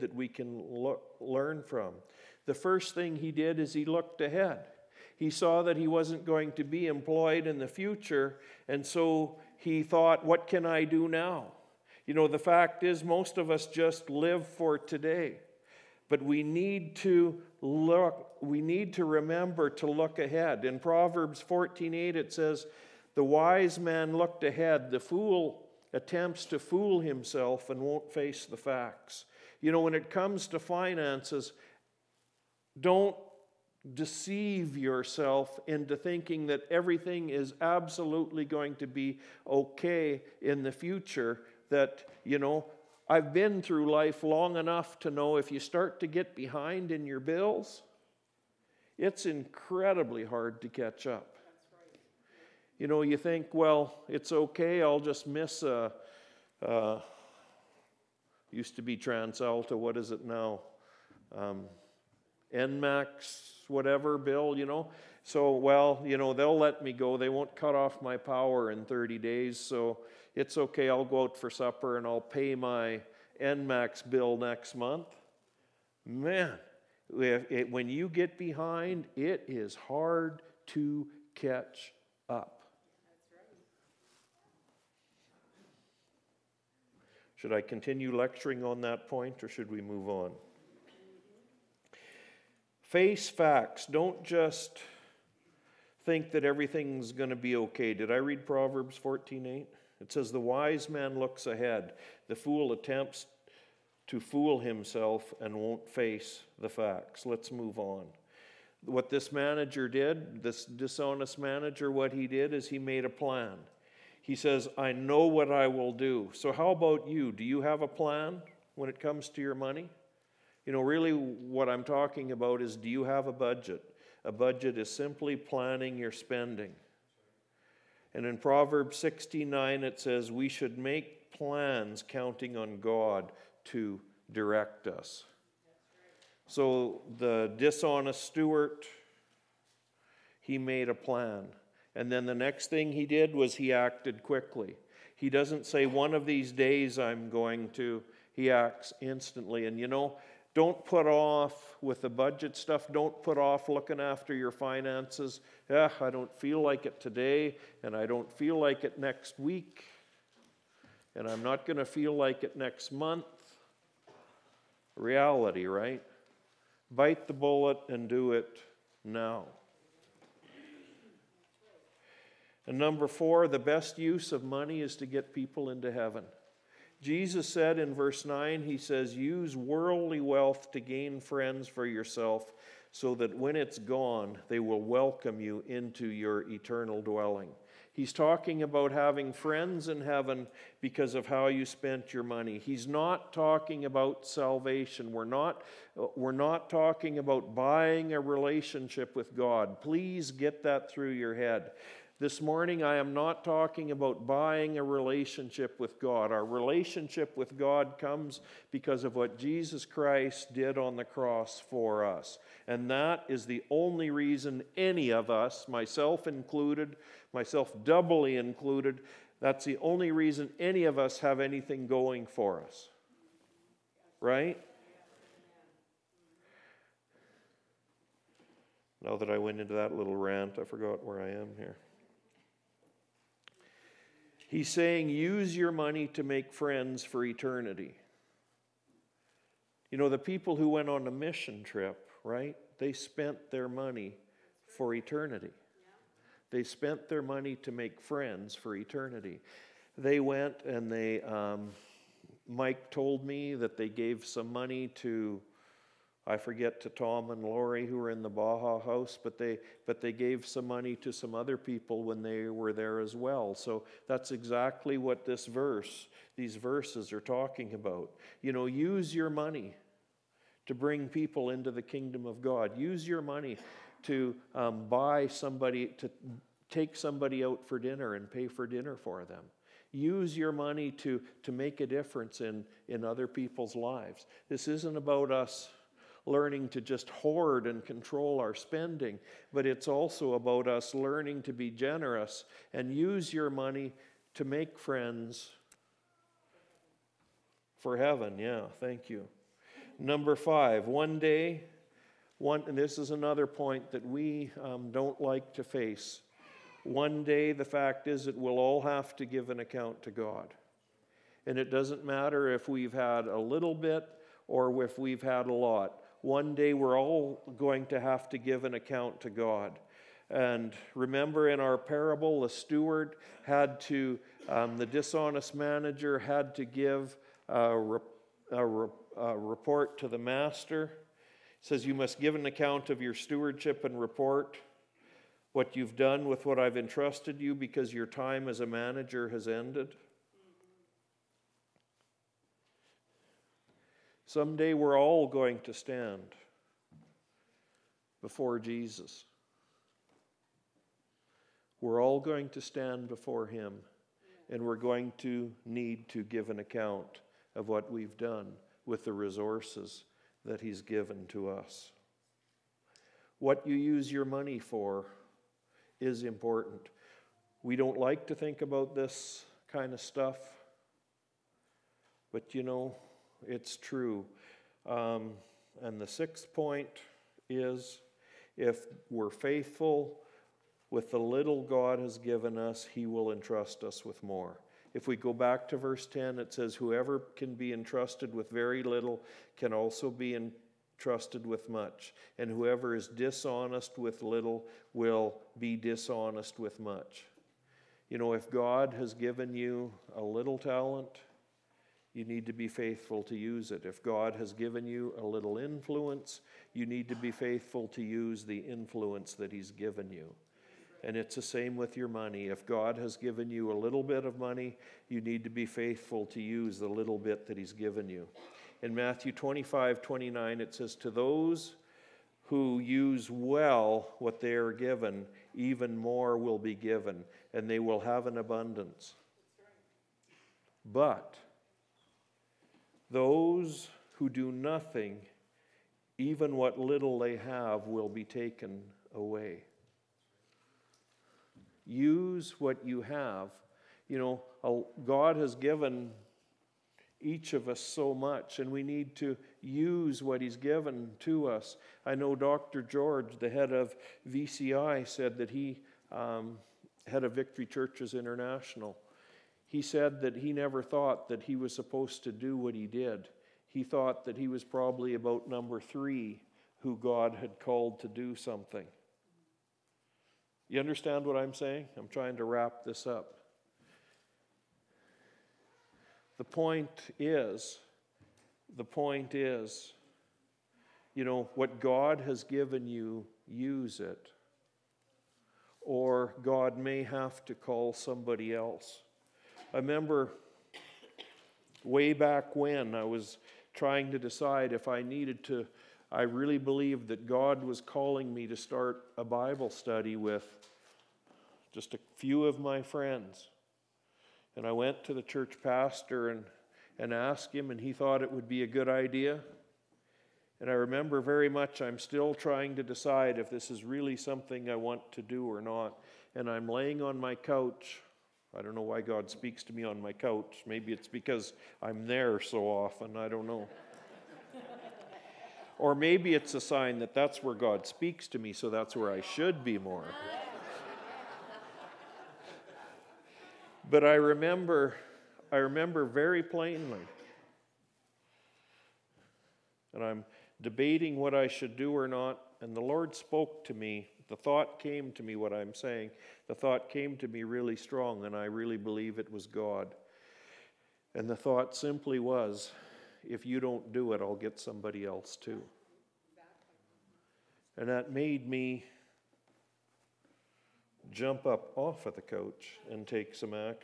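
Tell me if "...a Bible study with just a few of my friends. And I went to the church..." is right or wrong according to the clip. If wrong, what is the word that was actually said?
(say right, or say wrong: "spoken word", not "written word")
right.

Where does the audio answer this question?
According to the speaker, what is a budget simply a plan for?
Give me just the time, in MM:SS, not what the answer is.
02:05.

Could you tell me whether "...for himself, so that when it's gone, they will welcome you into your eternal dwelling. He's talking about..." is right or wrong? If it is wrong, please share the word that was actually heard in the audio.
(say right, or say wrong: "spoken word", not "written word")
wrong: "yourself", not "himself".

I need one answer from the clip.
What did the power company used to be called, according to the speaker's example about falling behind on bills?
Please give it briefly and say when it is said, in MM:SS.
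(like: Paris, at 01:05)
TransAlta, at 00:58.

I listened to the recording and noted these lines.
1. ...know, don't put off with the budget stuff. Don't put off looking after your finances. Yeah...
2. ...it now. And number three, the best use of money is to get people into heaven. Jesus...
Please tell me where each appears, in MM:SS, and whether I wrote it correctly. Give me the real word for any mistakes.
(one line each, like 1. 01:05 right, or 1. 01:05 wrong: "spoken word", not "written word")
1. 02:29 right
2. 02:48 wrong: "four", not "three".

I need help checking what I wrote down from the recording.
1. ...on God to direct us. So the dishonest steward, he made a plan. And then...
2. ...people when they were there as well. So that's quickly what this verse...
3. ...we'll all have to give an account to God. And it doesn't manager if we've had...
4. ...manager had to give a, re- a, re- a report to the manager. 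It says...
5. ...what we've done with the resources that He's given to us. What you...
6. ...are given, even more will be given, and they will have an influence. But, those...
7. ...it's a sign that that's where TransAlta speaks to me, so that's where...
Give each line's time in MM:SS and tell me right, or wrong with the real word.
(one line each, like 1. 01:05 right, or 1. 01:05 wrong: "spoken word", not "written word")
1. 02:12 right
2. 04:21 wrong: "exactly", not "quickly"
3. 05:08 wrong: "matter", not "manager"
4. 05:25 wrong: "master", not "manager"
5. 05:57 right
6. 07:04 wrong: "abundance", not "influence"
7. 08:46 wrong: "God", not "TransAlta".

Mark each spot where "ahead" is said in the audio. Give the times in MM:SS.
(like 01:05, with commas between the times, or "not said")
00:04, 00:20, 00:24, 01:41.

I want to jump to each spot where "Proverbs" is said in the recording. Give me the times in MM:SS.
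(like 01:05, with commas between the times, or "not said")
00:20, 01:38, 02:08.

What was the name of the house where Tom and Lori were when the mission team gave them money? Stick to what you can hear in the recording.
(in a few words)
Baja House.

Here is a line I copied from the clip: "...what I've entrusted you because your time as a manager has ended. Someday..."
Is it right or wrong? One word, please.
right.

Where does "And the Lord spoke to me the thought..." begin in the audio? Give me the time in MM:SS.
09:02.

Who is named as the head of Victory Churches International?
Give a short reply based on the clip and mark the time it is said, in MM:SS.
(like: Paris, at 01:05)
Dr. George, at 07:32.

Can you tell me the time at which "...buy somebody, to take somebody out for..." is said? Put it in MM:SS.
04:34.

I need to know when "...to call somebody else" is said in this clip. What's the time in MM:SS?
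08:07.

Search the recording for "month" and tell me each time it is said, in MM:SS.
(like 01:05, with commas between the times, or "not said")
01:14, 02:42.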